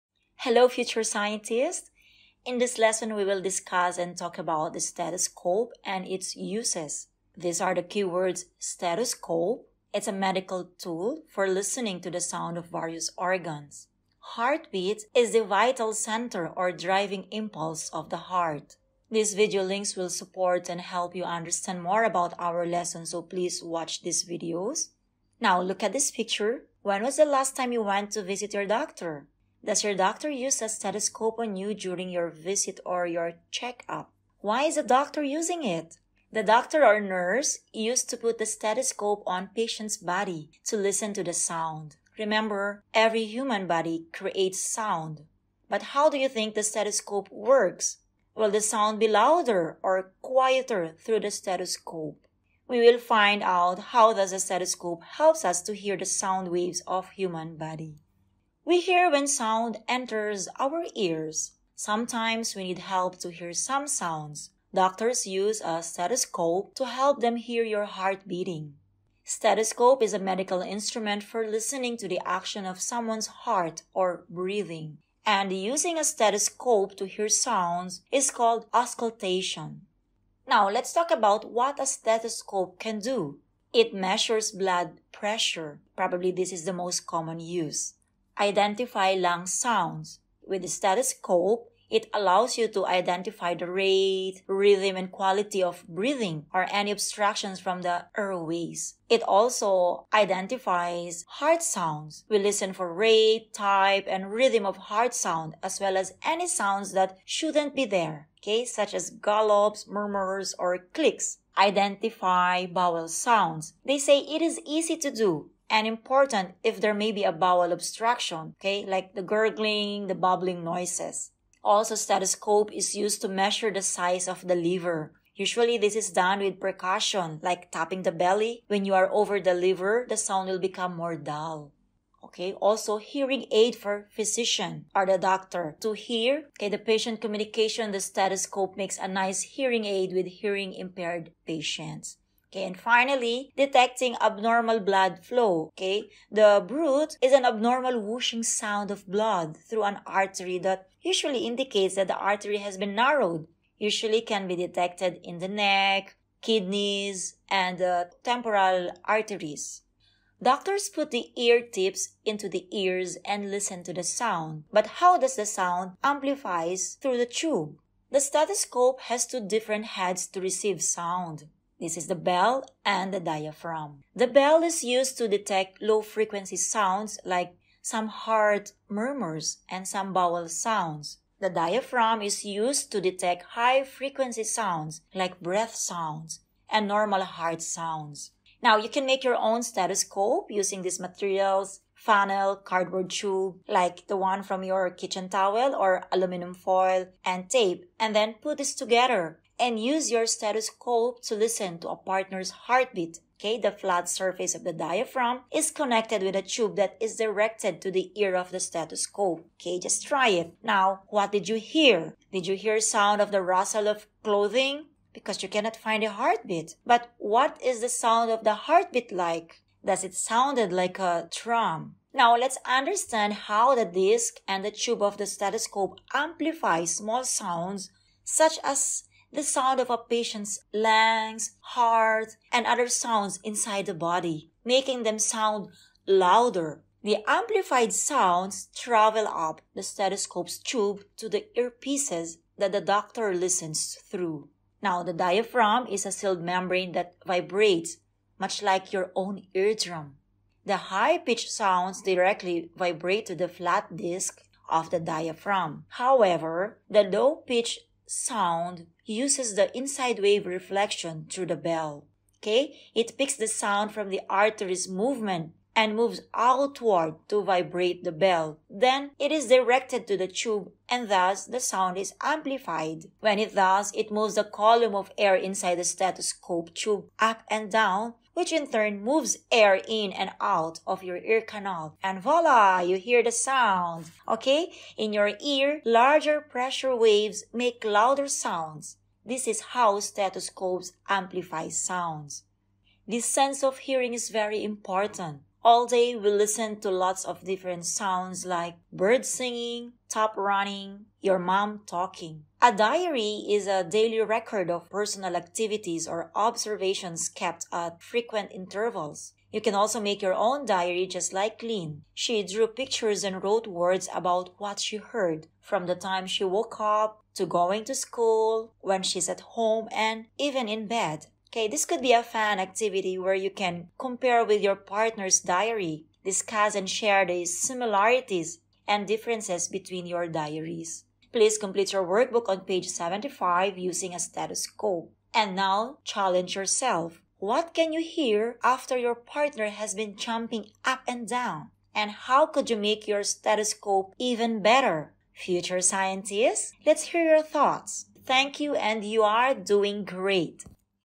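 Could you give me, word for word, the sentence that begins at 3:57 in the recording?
The amplified sounds travel up the stethoscope's tube to the earpieces that the doctor listens through.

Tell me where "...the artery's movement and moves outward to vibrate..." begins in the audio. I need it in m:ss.
4:24.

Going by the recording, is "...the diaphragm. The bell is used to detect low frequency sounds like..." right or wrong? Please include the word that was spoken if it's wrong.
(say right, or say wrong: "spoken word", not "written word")
right.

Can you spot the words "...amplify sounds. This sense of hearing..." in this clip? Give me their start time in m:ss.
4:51.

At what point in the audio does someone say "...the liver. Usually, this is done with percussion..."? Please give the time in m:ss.
2:04.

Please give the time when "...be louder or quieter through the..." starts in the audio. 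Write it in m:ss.
0:48.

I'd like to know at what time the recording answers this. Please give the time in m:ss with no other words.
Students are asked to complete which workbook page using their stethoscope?
5:32.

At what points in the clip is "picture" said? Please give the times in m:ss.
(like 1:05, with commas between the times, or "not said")
0:26, 5:12.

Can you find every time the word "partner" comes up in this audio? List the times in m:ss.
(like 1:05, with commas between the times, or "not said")
3:21, 5:24, 5:39.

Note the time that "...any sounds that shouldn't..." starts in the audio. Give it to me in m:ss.
1:46.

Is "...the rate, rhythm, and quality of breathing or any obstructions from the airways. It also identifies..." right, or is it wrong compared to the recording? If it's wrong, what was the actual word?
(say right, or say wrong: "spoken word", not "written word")
right.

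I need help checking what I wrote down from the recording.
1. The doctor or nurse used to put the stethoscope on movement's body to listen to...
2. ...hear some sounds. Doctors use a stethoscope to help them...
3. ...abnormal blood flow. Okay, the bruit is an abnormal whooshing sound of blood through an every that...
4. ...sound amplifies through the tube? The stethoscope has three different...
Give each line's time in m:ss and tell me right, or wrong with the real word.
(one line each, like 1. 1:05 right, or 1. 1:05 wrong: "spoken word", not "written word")
1. 0:36 wrong: "patient", not "movement"
2. 1:03 right
3. 2:24 wrong: "artery", not "every"
4. 2:45 wrong: "two", not "three".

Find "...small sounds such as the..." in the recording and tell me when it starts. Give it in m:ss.
3:46.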